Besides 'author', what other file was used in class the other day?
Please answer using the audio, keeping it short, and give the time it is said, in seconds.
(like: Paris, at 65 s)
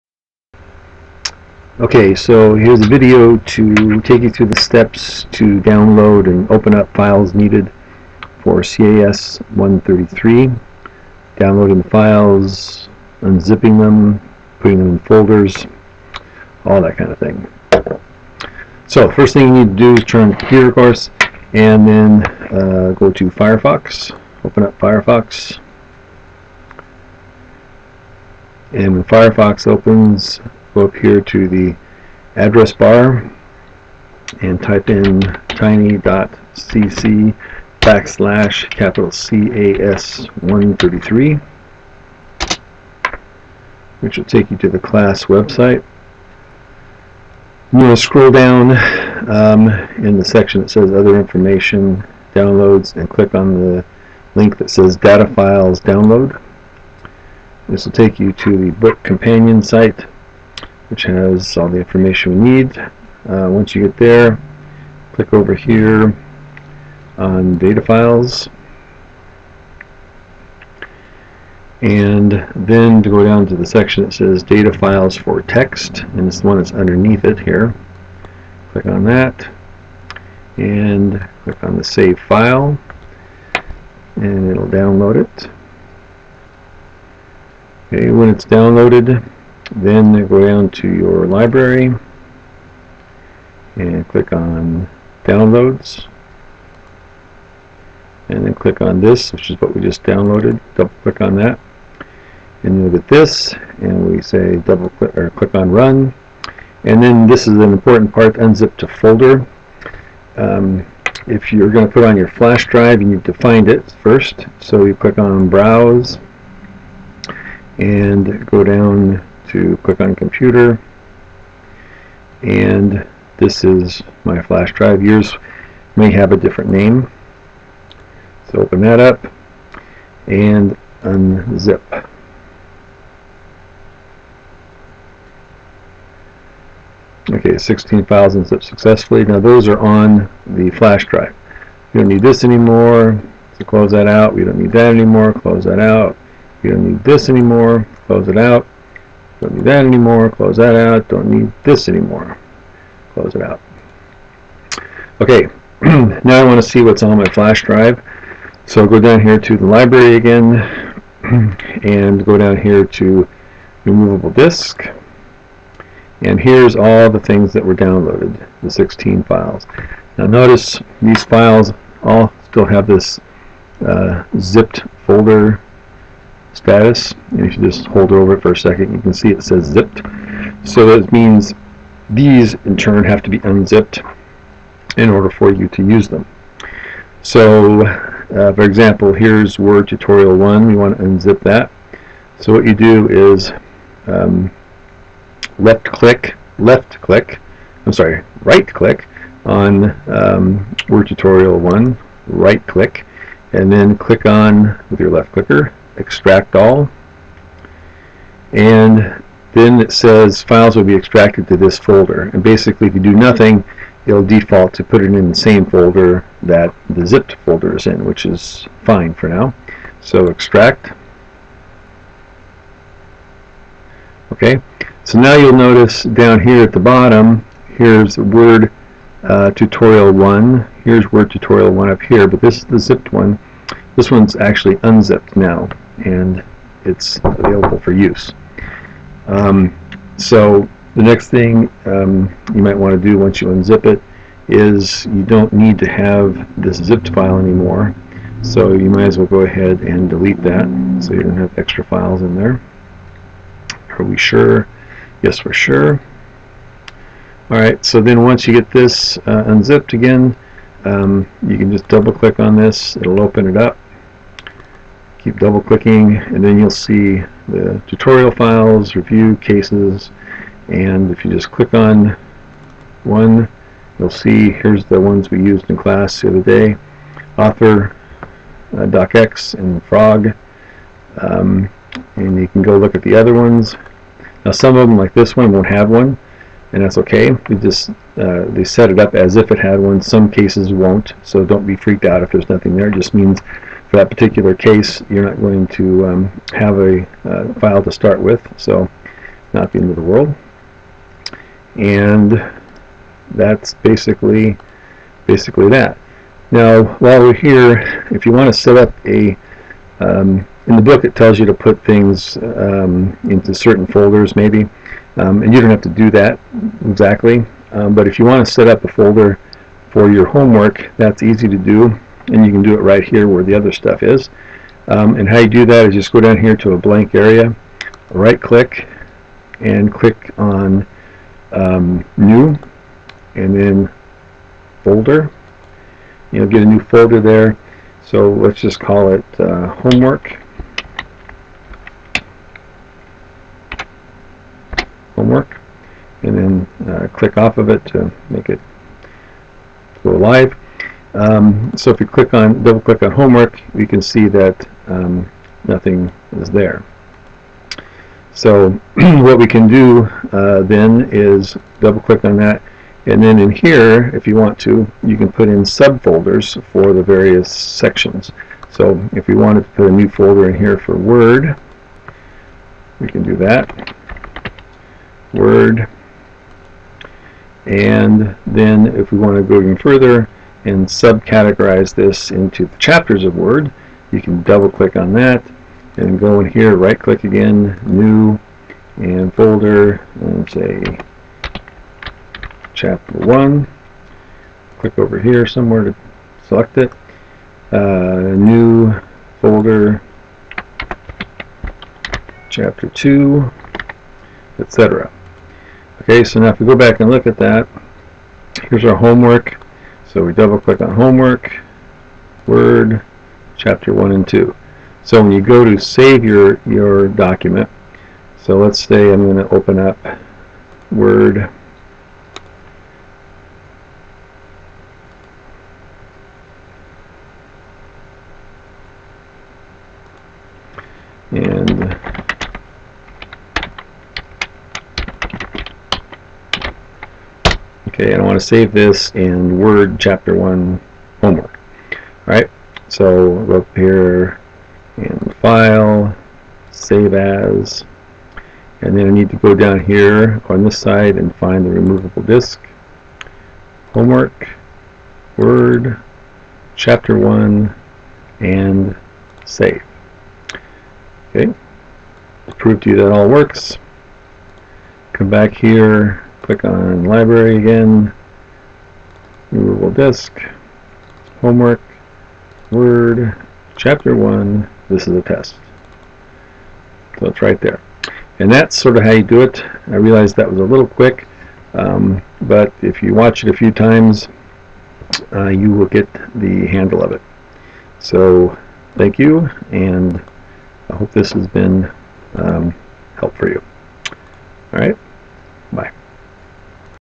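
frog, at 279 s.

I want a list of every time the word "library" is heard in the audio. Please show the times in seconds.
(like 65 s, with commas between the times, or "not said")
91 s, 159 s, 467 s.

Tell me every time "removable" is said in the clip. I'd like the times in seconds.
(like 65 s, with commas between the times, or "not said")
163 s, 451 s.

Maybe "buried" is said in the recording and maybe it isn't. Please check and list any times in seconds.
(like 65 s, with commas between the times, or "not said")
not said.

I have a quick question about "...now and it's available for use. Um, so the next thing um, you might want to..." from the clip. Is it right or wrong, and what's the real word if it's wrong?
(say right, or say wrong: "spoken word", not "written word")
right.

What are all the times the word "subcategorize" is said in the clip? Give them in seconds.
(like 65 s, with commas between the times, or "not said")
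380 s.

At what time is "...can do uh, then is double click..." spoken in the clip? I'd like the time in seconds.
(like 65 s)
359 s.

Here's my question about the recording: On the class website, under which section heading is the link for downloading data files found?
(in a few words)
other information downloads.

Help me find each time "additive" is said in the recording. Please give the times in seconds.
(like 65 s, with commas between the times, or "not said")
not said.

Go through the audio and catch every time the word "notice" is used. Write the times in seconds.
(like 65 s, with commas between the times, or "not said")
170 s, 225 s.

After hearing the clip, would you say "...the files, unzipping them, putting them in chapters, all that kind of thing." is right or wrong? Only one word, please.
wrong.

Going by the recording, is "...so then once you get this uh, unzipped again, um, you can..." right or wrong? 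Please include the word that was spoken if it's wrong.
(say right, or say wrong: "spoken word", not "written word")
right.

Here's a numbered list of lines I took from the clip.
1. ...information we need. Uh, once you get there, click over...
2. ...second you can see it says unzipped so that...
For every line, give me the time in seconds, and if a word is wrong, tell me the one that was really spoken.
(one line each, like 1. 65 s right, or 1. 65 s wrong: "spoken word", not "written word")
1. 61 s right
2. 178 s wrong: "zipped", not "unzipped".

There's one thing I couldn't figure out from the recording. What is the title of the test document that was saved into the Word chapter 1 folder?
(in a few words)
this is a test.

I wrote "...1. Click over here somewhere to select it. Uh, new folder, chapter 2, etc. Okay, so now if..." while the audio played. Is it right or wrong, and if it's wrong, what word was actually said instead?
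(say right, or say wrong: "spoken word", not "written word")
right.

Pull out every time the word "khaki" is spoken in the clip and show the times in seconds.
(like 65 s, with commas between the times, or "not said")
not said.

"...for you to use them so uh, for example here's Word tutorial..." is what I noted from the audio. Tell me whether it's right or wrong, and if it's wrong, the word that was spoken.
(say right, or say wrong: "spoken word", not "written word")
right.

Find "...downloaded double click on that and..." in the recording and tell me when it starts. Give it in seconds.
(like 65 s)
100 s.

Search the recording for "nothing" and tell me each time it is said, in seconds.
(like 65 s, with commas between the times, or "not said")
213 s, 292 s, 355 s.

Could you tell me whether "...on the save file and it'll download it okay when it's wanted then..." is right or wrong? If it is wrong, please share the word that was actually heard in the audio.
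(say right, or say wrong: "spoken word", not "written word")
wrong: "downloaded", not "wanted".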